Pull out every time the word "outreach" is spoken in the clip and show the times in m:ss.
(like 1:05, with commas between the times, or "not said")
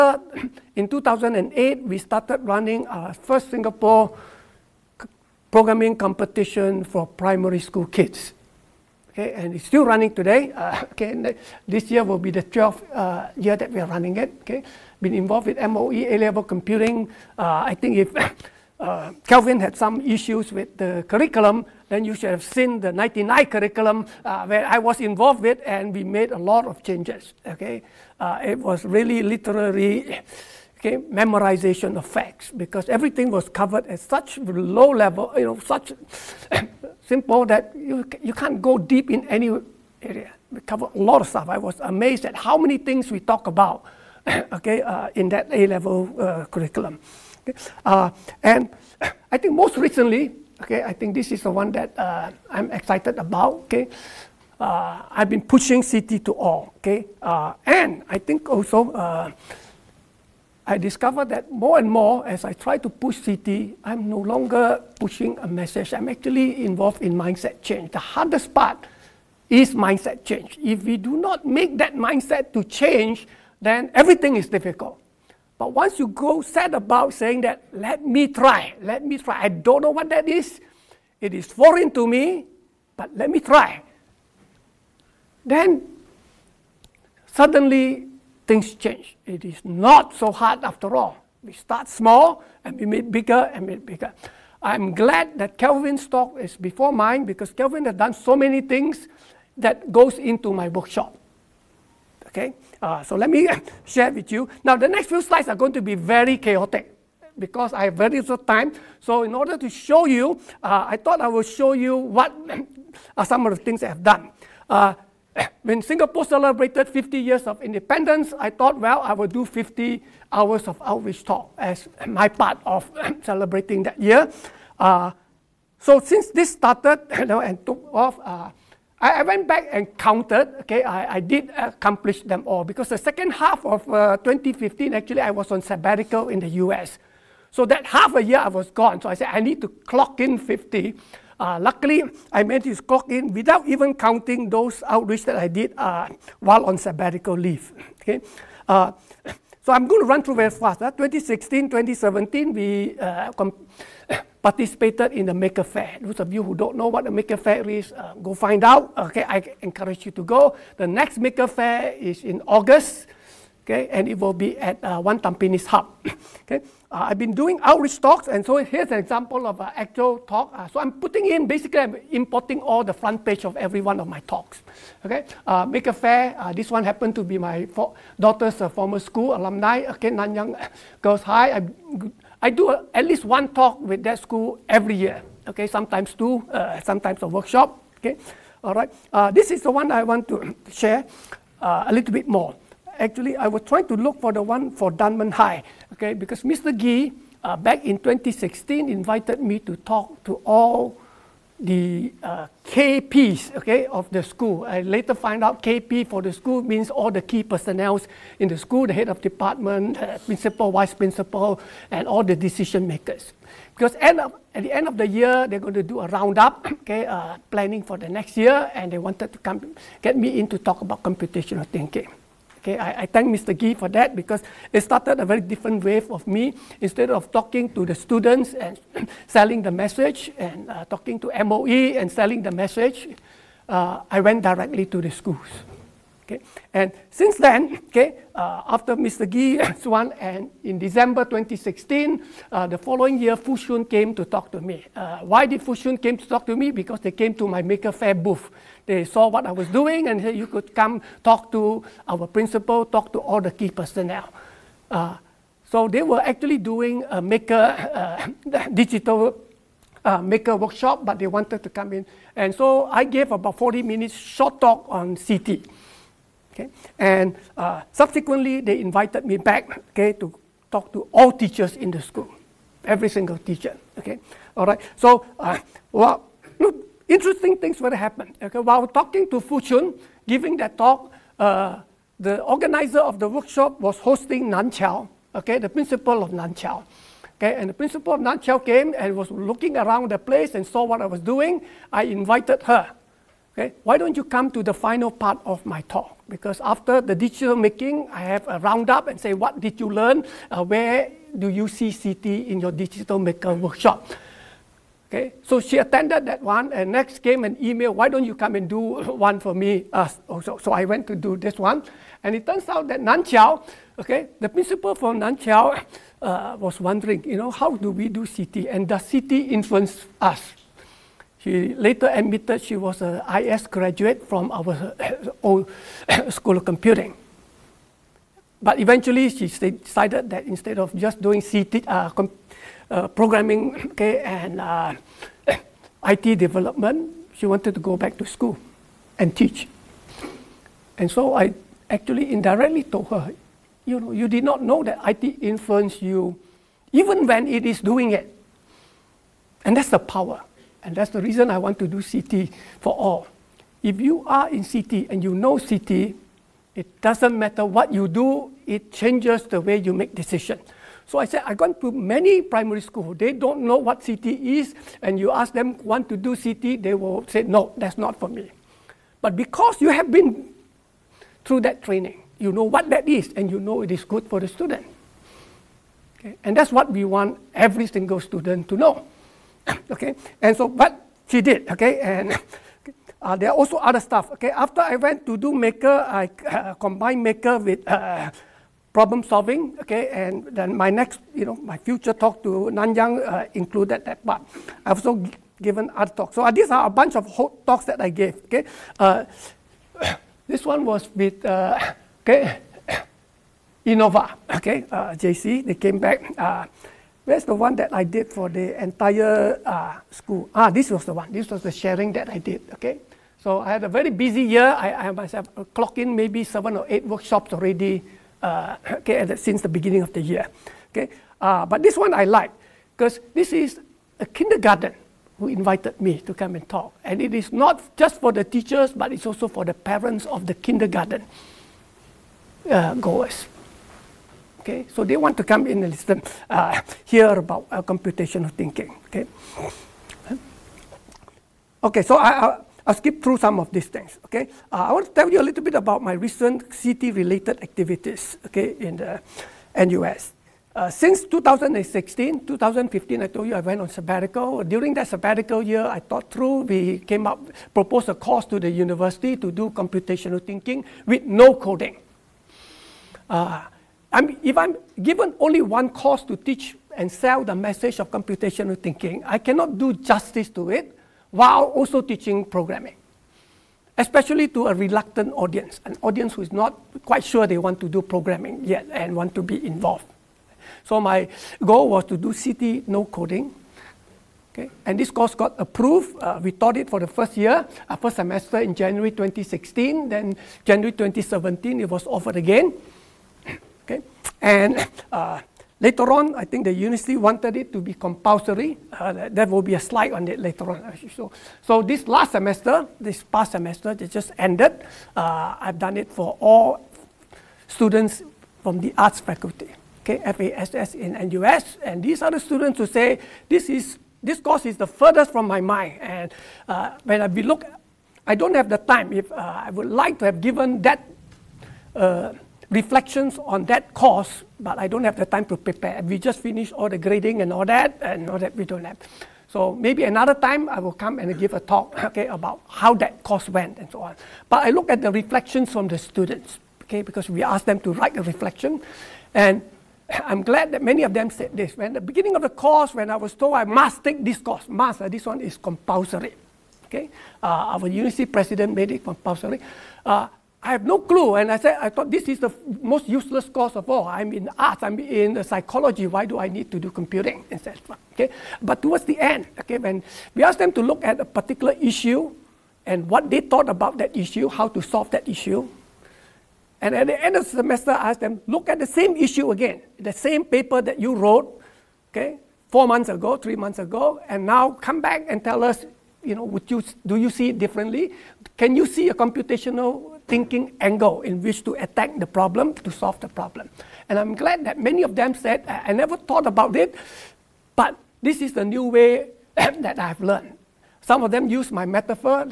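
2:00, 2:24, 2:47.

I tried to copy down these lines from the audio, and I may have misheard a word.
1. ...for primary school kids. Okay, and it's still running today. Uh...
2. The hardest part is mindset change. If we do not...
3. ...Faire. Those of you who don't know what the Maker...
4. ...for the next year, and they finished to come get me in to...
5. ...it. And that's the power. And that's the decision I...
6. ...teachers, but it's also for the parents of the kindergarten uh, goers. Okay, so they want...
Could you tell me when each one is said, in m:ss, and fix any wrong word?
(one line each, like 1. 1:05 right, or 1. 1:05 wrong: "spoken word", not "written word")
1. 0:06 right
2. 1:07 right
3. 2:35 right
4. 3:37 wrong: "wanted", not "finished"
5. 5:48 wrong: "reason", not "decision"
6. 7:08 right.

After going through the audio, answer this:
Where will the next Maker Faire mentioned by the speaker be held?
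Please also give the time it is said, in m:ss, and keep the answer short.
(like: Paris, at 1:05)
One Tampines Hub, at 2:45.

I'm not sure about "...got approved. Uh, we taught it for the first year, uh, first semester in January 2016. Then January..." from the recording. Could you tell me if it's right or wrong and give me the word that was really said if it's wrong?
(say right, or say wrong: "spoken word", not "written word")
right.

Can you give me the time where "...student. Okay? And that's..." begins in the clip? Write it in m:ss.
6:14.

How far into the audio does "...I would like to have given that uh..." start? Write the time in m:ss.
8:39.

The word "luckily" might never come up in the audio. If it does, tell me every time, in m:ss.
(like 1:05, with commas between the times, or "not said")
2:21.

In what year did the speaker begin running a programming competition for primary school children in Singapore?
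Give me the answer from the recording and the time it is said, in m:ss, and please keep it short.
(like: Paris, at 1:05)
2008, at 0:00.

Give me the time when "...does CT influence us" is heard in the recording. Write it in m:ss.
5:18.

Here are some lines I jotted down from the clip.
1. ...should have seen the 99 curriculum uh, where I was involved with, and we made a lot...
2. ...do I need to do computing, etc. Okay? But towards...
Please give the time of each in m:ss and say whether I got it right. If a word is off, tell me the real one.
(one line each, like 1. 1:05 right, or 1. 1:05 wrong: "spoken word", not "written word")
1. 0:22 right
2. 9:16 right.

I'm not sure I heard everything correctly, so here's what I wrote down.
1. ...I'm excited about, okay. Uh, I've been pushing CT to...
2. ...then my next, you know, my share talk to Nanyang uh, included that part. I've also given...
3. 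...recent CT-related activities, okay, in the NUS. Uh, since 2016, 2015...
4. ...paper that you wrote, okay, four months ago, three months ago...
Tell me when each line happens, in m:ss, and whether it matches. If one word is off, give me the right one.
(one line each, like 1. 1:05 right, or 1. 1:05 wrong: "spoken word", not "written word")
1. 0:52 right
2. 6:30 wrong: "future", not "share"
3. 7:26 right
4. 9:30 right.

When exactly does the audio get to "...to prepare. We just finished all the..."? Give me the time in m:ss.
8:45.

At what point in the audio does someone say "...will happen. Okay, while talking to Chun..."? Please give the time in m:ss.
4:37.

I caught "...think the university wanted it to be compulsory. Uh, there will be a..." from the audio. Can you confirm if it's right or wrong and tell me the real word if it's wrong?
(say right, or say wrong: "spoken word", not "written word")
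right.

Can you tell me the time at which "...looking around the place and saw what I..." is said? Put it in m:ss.
4:49.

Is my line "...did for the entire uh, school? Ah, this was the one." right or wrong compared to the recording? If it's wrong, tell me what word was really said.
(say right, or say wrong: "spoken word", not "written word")
right.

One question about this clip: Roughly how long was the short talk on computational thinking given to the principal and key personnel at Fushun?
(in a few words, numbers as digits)
40 minutes.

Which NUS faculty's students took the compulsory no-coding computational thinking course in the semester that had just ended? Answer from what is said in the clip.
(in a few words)
FASS.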